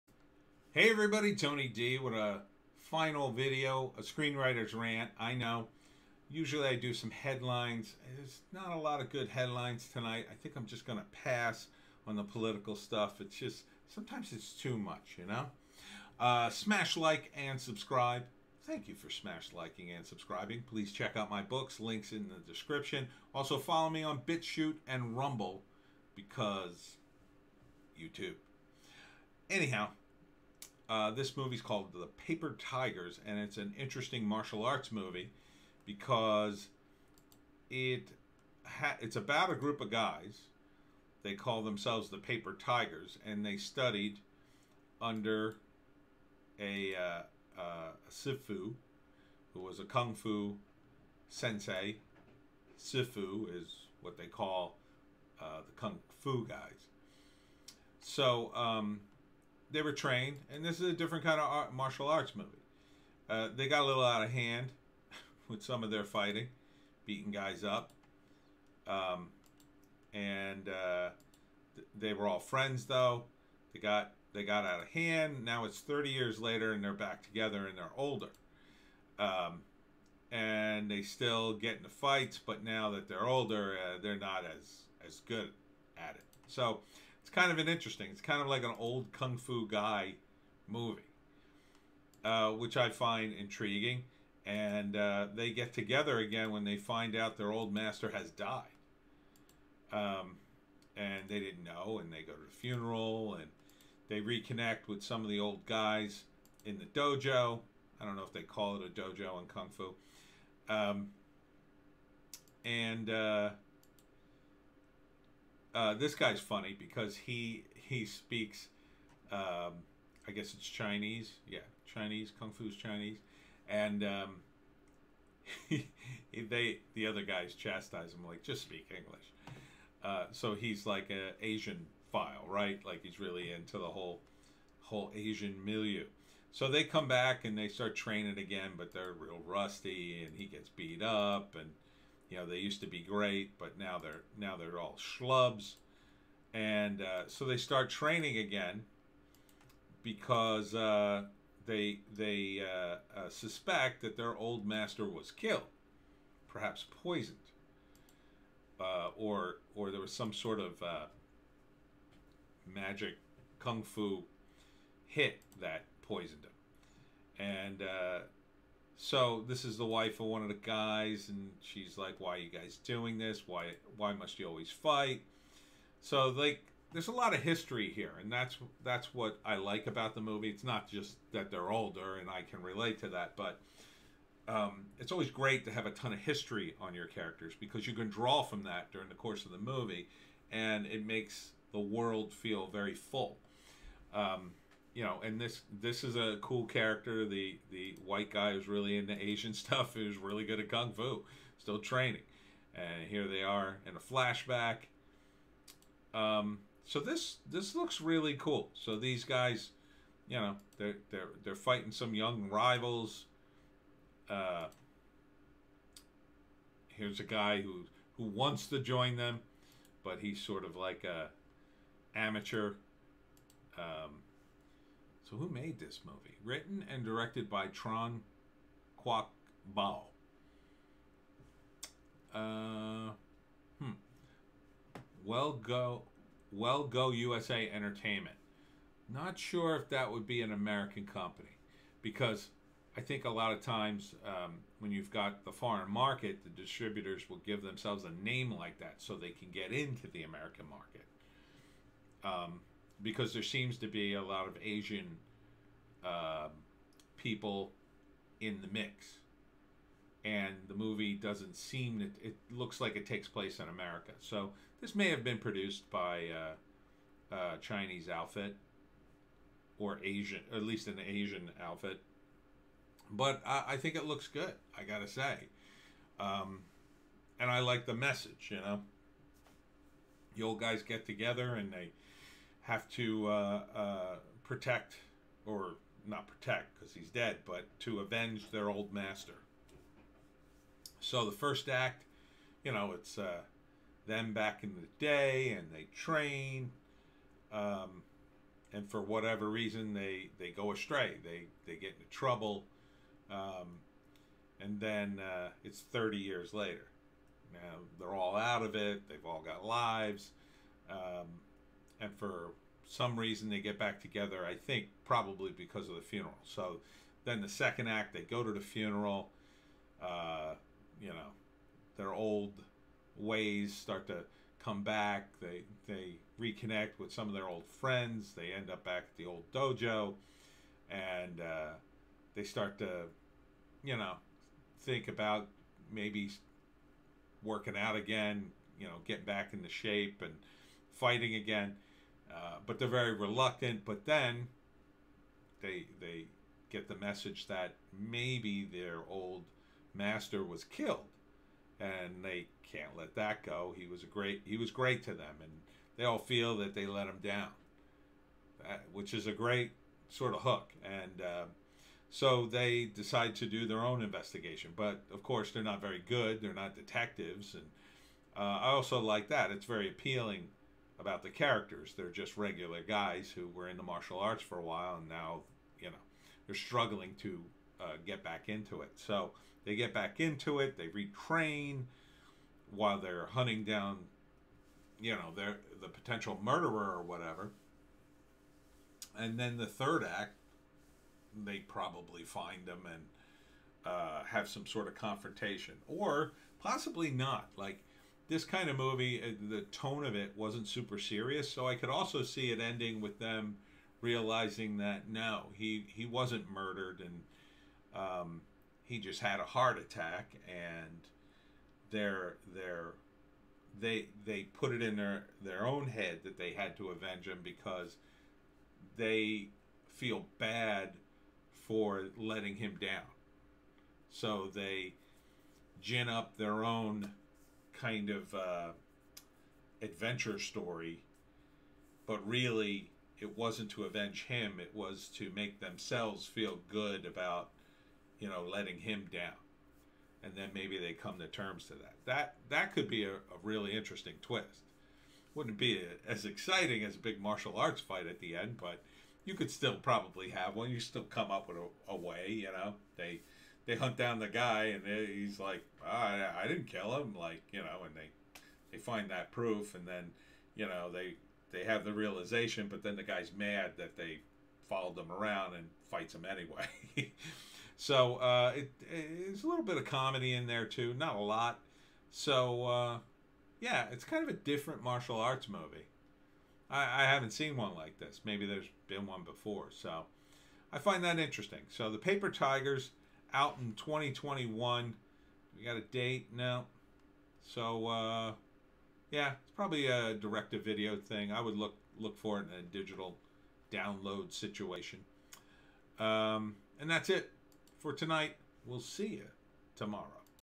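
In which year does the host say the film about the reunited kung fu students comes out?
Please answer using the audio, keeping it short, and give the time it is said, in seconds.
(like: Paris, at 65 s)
2021, at 483 s.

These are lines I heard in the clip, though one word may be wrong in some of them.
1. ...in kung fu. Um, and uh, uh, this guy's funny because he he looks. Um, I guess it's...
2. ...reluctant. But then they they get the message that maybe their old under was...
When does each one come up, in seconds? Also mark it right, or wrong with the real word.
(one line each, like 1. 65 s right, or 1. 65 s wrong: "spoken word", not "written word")
1. 109 s wrong: "speaks", not "looks"
2. 343 s wrong: "master", not "under".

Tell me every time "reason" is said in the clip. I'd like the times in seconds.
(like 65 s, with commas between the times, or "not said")
299 s, 313 s.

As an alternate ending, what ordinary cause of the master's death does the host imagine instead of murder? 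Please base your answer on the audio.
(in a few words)
heart attack.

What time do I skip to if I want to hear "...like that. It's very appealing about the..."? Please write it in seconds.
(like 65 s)
369 s.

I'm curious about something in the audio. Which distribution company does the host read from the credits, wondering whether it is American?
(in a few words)
Well Go USA Entertainment.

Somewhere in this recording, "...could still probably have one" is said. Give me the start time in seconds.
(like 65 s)
449 s.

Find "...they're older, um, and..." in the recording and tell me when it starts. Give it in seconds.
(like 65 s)
77 s.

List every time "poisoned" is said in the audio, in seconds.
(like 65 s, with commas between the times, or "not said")
157 s, 166 s.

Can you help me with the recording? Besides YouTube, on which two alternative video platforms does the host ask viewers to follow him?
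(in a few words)
BitChute and Rumble.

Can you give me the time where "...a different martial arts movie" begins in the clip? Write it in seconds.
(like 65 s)
474 s.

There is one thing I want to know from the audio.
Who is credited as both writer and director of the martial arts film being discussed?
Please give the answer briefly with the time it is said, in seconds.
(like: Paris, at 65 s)
Tran Quoc Bao, at 227 s.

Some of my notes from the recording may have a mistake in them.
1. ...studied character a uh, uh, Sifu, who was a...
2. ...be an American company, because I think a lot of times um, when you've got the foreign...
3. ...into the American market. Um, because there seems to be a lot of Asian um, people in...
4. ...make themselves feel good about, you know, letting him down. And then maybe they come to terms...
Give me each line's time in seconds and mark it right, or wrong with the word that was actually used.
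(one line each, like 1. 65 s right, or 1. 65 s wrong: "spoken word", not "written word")
1. 43 s wrong: "under", not "character"
2. 240 s right
3. 249 s right
4. 435 s right.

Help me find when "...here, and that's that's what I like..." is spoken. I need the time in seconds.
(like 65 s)
177 s.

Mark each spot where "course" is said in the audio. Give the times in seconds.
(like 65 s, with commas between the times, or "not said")
189 s, 365 s.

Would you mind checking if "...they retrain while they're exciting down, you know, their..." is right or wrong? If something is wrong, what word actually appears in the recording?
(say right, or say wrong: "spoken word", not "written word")
wrong: "hunting", not "exciting".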